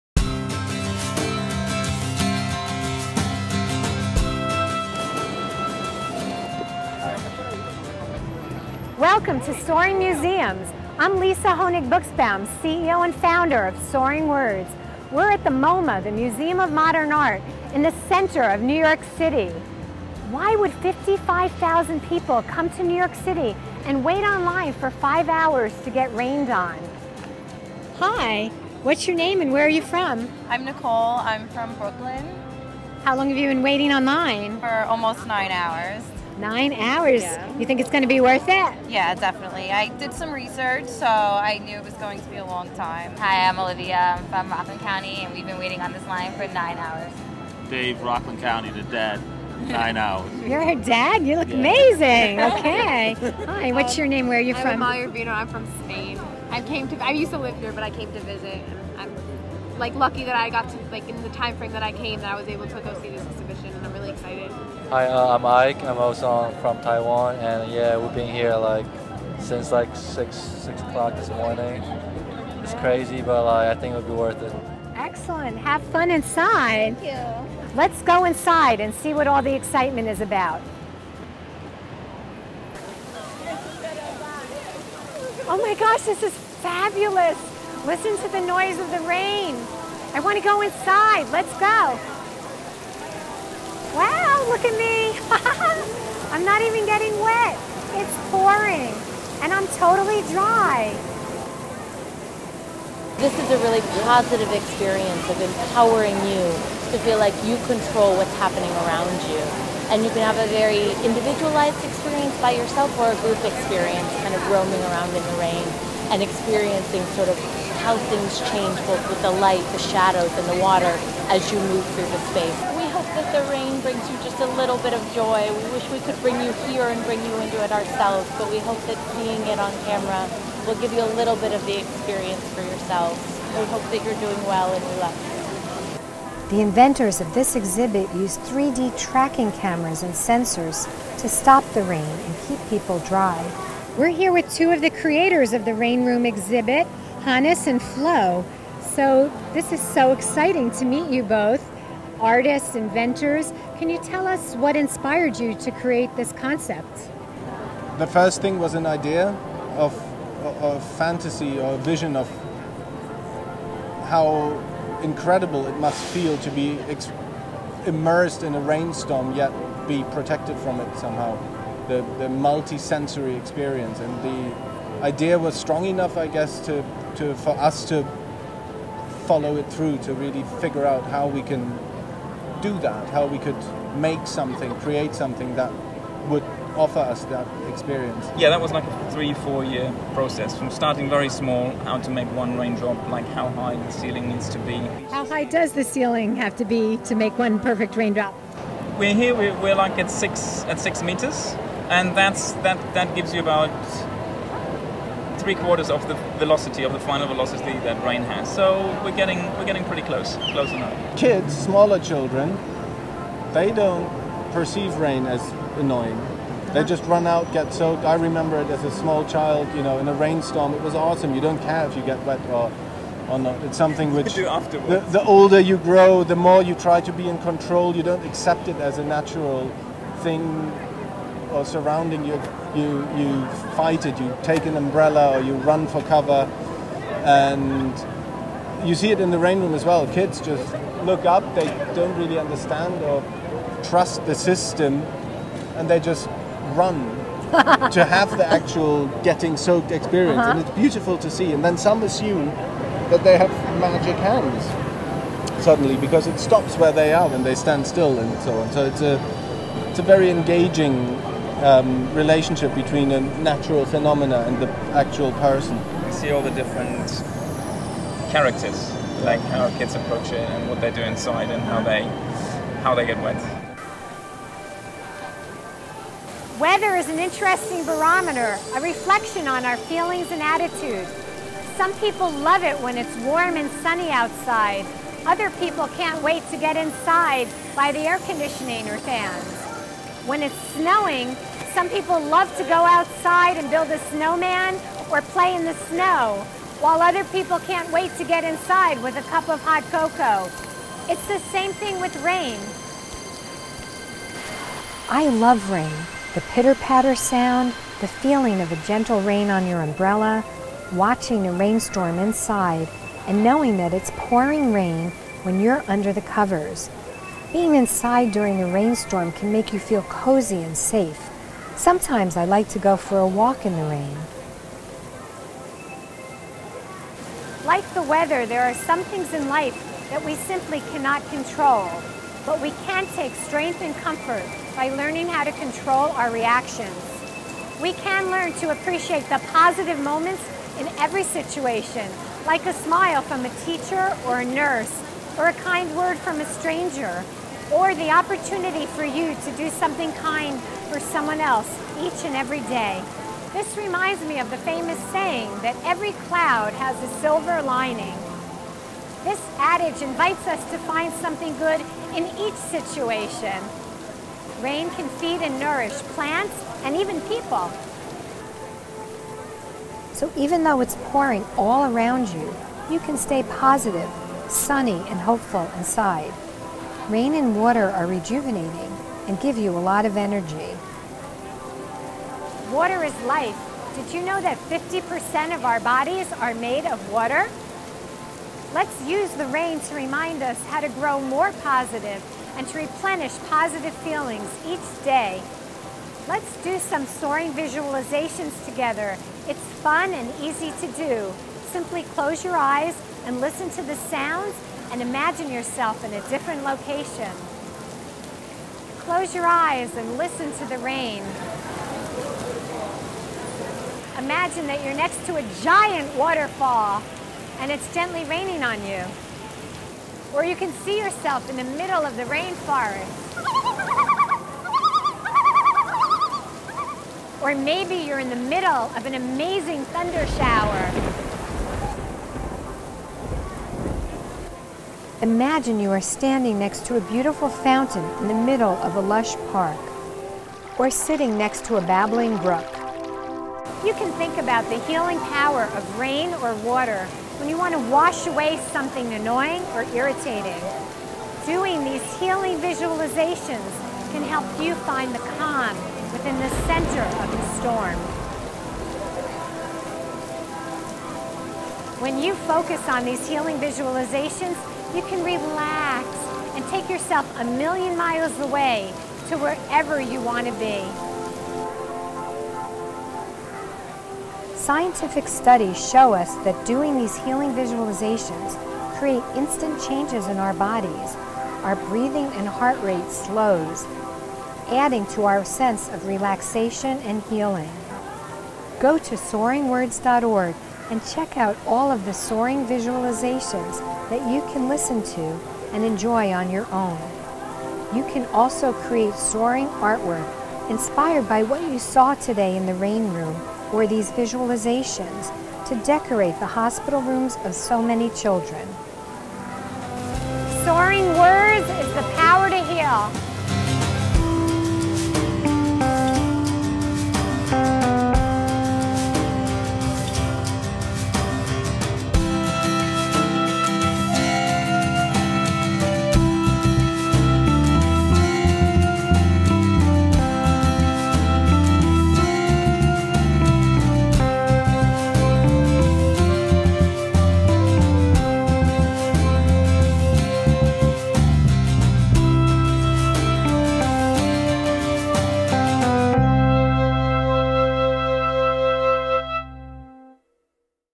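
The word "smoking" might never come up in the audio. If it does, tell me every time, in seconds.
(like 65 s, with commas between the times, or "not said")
not said.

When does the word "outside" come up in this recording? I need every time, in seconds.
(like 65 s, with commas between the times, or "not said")
284 s, 292 s.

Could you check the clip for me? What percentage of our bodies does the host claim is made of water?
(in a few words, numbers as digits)
50%.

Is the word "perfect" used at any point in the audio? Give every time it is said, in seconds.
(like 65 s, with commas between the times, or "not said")
197 s.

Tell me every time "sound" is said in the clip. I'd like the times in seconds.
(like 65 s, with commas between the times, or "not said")
307 s, 403 s.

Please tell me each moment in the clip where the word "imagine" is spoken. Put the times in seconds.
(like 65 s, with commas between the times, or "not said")
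405 s, 414 s, 435 s.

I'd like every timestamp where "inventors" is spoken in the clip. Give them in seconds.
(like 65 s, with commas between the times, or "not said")
136 s, 152 s.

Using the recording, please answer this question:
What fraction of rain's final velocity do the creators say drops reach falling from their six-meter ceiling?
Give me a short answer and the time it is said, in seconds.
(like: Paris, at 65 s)
Three quarters, at 205 s.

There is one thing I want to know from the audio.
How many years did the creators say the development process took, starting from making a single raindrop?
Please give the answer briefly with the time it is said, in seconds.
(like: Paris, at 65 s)
3 to 4 years, at 189 s.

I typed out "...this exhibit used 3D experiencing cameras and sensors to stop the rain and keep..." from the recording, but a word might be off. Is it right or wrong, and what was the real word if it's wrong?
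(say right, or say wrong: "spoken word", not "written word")
wrong: "tracking", not "experiencing".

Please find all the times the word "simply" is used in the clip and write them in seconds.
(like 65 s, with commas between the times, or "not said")
330 s, 401 s.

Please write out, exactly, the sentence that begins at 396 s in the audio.
Let's do some soaring visualizations together.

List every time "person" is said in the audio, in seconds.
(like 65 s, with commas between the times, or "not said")
265 s.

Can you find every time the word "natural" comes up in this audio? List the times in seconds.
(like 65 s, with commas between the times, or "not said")
229 s, 263 s.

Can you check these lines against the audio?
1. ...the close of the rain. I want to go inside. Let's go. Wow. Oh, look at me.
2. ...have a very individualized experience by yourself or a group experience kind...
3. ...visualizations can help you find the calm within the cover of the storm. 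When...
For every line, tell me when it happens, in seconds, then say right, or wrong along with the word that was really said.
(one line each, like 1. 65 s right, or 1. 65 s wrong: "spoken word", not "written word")
1. 88 s wrong: "noise", not "close"
2. 110 s right
3. 452 s wrong: "center", not "cover".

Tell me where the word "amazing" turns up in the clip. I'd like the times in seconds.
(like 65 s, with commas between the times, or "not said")
51 s, 429 s.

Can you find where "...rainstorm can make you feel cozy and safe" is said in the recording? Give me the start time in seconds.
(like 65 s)
318 s.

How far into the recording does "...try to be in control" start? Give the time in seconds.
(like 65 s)
226 s.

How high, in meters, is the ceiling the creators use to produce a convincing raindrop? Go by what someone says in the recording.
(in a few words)
6 meters.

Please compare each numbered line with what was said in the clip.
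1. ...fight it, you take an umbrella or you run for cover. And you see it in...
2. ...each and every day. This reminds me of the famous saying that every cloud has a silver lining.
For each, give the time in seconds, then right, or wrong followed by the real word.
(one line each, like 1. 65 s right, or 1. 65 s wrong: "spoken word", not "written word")
1. 233 s right
2. 352 s right.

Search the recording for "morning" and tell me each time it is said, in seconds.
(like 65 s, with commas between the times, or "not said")
71 s.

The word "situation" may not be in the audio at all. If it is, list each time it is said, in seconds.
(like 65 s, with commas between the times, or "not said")
341 s, 362 s.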